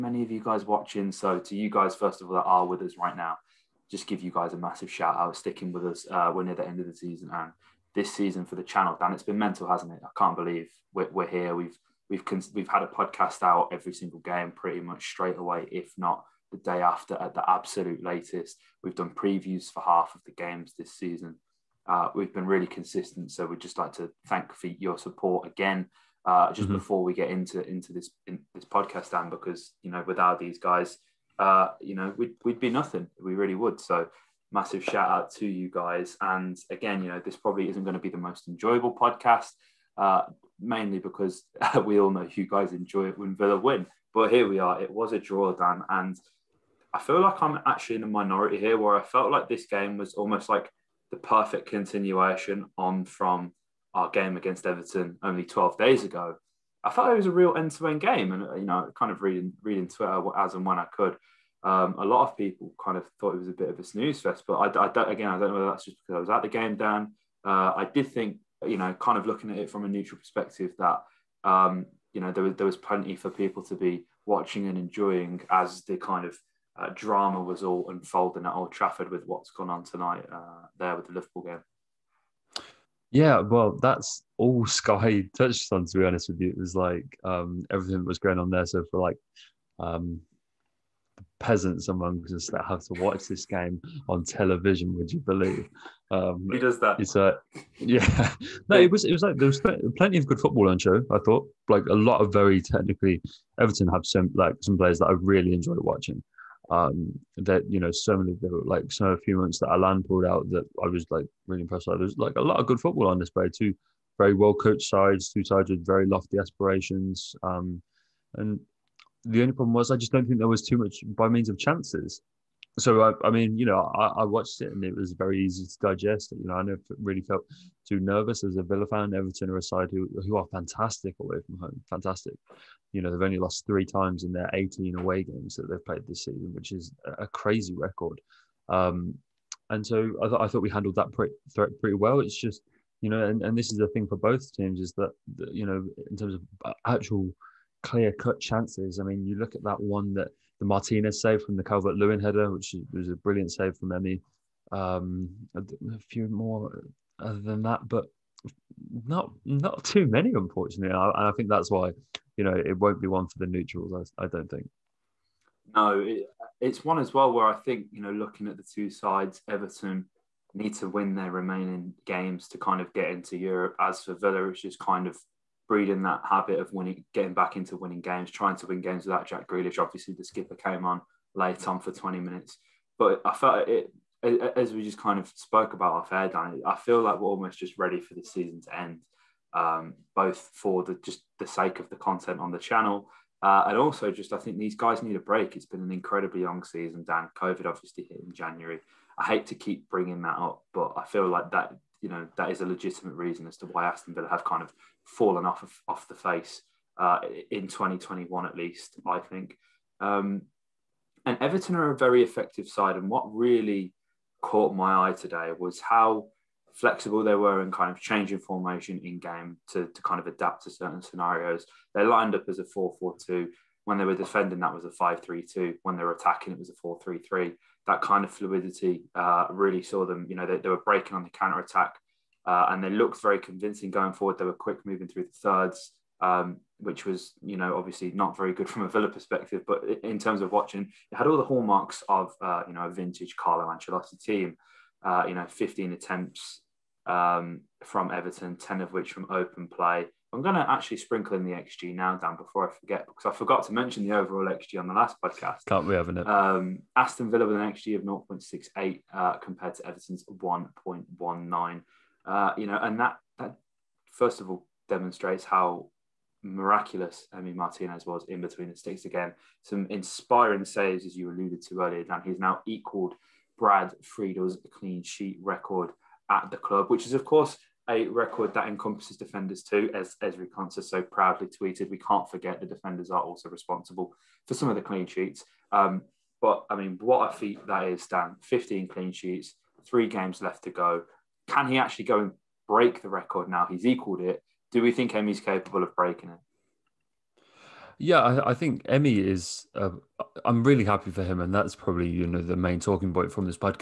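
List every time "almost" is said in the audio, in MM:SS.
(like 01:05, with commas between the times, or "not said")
00:50, 03:07.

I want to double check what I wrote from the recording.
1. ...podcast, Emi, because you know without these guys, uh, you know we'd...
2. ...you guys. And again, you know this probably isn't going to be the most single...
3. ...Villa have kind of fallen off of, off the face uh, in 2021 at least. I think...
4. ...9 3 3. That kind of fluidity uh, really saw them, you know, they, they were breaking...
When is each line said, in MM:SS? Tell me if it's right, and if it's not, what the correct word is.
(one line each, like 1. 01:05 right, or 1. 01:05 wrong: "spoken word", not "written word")
1. 00:28 wrong: "Dan", not "Emi"
2. 00:35 wrong: "enjoyable", not "single"
3. 03:24 right
4. 03:46 wrong: "4", not "9".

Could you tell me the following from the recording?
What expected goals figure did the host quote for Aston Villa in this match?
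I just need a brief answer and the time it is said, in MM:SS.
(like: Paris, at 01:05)
0.68, at 04:18.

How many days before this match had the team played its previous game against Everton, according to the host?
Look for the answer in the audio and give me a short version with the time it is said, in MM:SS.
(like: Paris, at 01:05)
12, at 00:55.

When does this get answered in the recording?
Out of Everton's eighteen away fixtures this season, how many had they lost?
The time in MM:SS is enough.
02:13.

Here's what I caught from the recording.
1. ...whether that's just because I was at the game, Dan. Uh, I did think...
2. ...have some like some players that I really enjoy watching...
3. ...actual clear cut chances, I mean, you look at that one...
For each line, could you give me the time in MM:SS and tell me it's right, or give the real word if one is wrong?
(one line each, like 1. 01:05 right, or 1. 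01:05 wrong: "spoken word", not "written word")
1. 01:05 right
2. 01:43 right
3. 02:26 right.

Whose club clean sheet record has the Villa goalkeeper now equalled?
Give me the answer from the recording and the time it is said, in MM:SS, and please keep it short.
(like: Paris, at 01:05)
Brad Friedel, at 04:33.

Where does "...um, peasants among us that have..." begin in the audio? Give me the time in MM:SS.
01:29.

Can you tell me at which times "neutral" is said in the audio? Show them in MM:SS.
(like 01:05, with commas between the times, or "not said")
01:09, 02:43.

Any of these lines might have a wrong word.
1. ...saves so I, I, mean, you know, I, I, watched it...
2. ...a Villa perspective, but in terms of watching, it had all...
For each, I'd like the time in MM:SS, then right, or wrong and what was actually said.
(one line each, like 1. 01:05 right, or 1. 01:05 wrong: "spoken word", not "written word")
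1. 02:01 wrong: "chances", not "saves"
2. 03:58 right.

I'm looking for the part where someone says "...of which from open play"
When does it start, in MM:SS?
04:08.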